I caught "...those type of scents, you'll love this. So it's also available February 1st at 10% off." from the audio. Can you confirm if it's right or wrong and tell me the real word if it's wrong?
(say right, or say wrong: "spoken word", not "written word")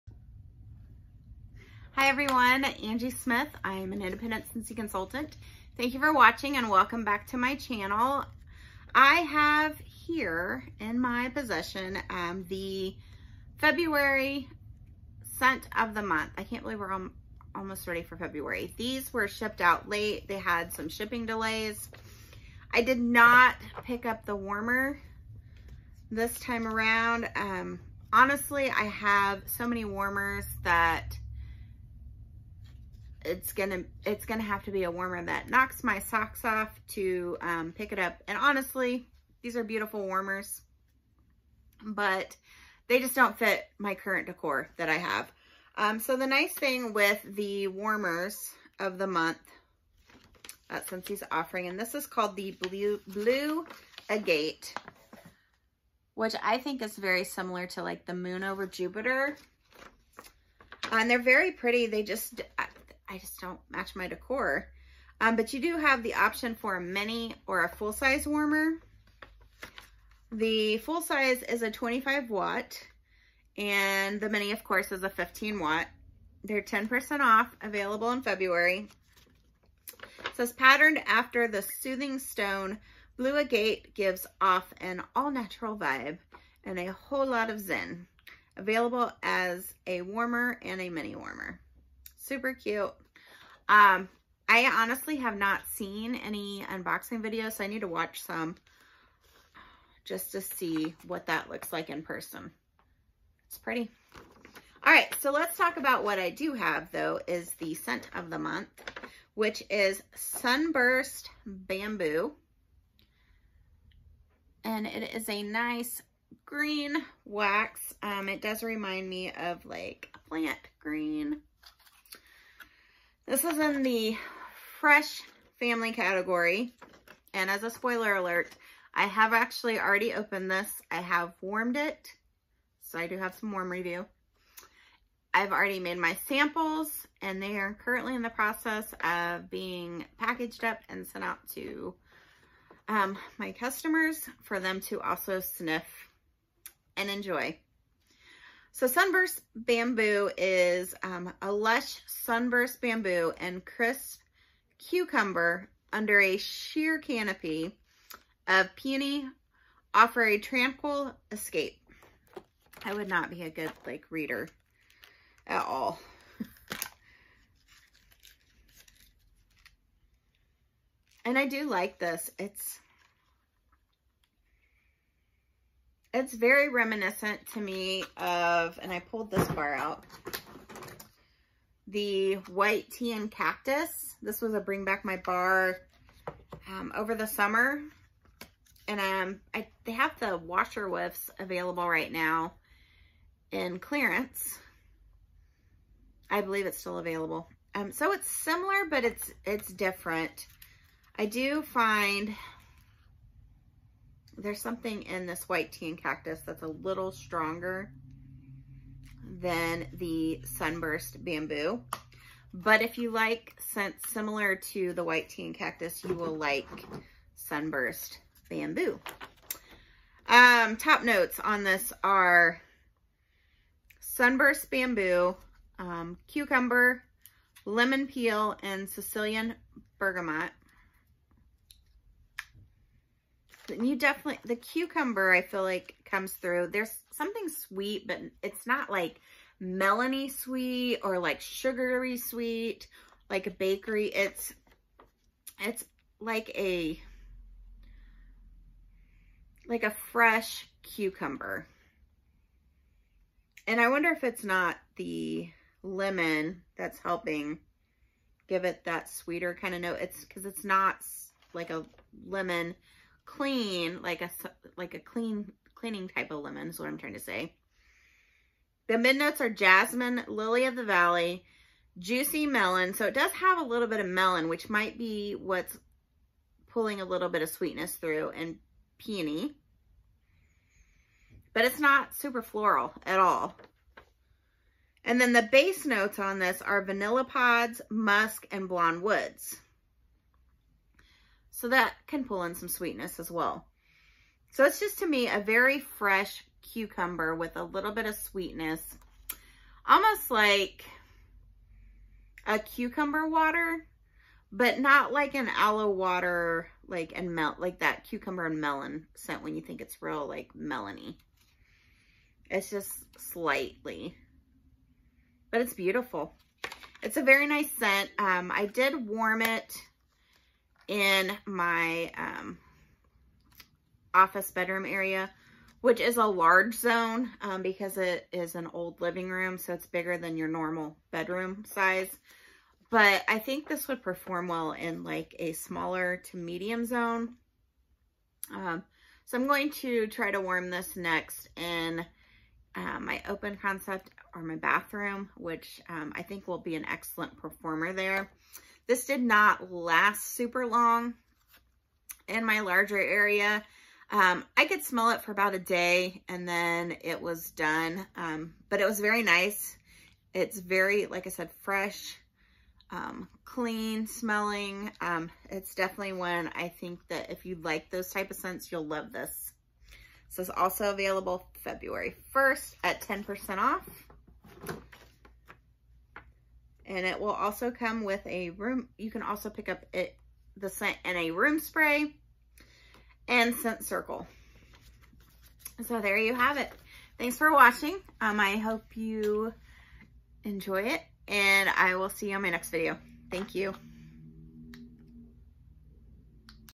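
right.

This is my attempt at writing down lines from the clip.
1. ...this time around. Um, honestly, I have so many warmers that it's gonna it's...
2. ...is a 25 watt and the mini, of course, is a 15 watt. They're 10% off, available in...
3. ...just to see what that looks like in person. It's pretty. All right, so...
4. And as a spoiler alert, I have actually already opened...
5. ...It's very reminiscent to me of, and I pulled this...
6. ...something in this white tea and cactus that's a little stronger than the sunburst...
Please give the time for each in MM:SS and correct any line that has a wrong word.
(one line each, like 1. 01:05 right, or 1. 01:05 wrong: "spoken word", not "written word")
1. 00:26 right
2. 01:11 right
3. 01:40 right
4. 02:07 right
5. 02:56 right
6. 03:24 right.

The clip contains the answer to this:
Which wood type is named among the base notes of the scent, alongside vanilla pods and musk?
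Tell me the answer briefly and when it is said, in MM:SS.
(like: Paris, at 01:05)
Blonde woods, at 04:48.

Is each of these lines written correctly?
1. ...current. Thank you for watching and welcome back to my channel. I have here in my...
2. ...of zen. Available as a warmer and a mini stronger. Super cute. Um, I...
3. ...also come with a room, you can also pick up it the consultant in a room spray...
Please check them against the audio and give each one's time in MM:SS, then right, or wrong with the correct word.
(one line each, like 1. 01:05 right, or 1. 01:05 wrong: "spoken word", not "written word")
1. 00:04 wrong: "consultant", not "current"
2. 01:27 wrong: "warmer", not "stronger"
3. 06:17 wrong: "scent", not "consultant".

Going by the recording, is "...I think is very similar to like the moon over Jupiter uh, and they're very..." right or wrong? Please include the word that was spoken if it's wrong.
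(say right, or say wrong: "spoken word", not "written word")
right.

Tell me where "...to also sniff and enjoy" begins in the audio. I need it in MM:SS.
02:24.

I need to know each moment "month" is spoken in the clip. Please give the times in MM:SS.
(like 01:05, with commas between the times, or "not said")
00:16, 00:49, 01:48.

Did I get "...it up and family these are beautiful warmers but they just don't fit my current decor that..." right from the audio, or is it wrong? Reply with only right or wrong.
wrong.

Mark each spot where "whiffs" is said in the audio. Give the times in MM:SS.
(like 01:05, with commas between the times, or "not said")
03:10.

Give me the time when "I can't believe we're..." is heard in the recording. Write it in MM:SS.
00:16.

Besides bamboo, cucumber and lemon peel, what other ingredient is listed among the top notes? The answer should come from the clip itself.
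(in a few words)
Sicilian bergamot.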